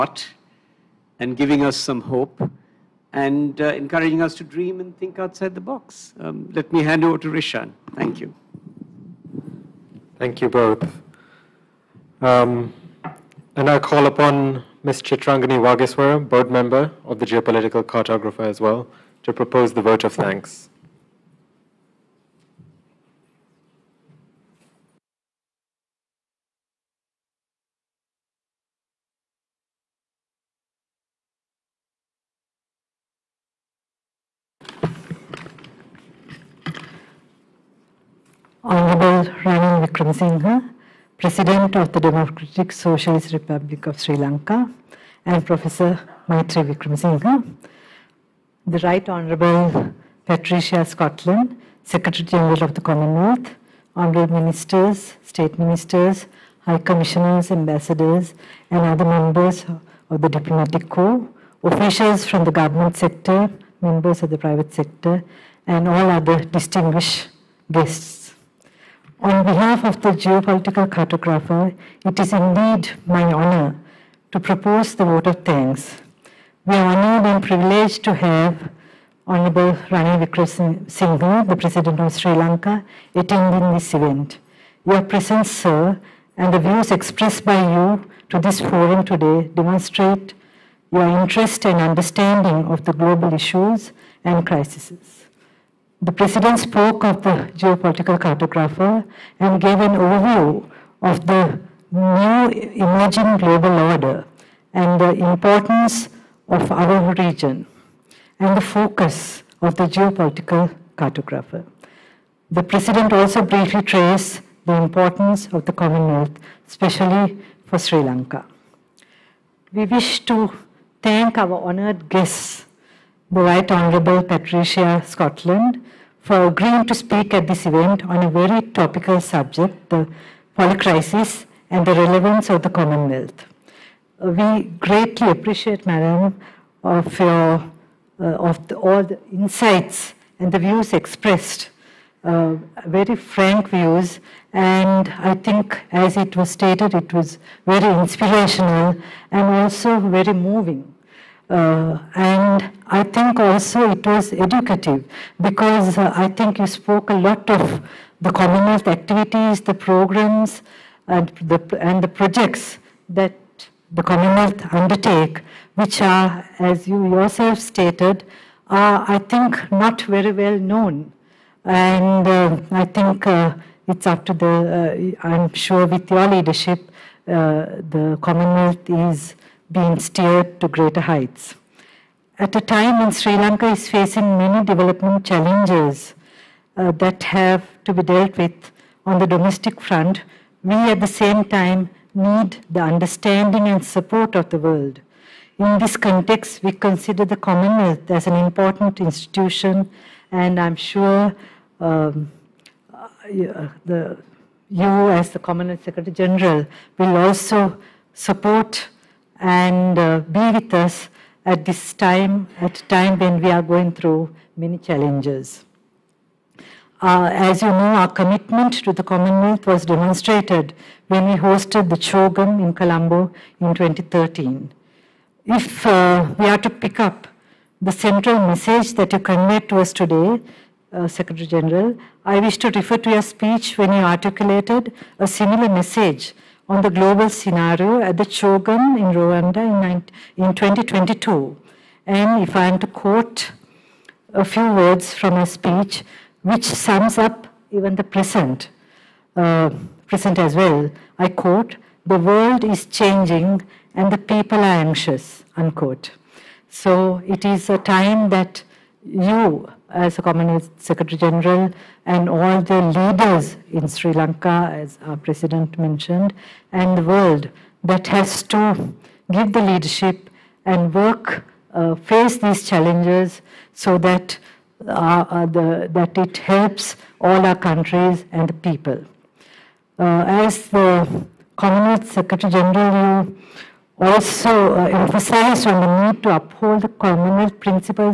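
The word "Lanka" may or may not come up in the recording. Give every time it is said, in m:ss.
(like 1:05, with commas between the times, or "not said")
0:44, 1:22, 1:57, 3:03, 4:24.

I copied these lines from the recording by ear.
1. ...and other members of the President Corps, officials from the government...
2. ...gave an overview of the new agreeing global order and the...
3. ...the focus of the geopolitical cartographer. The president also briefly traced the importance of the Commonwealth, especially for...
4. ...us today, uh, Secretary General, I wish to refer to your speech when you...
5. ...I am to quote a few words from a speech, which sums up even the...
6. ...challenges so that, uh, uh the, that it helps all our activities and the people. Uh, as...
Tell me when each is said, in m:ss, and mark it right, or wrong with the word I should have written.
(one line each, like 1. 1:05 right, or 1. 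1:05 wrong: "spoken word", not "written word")
1. 0:58 wrong: "Diplomatic", not "President"
2. 1:39 wrong: "emerging", not "agreeing"
3. 1:48 right
4. 3:49 right
5. 4:02 right
6. 4:32 wrong: "countries", not "activities".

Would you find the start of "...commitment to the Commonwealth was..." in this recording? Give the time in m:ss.
3:38.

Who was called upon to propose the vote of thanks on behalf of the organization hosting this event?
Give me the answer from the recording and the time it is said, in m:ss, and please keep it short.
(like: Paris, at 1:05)
Chitrangani Wagiswara, at 0:14.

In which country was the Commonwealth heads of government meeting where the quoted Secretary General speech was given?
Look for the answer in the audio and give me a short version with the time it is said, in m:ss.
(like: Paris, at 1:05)
Rwanda, at 3:59.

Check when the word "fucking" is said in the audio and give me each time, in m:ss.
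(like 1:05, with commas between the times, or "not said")
not said.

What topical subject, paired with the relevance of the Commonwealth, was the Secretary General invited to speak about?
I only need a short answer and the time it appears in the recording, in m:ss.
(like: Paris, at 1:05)
The polycrisis, at 2:09.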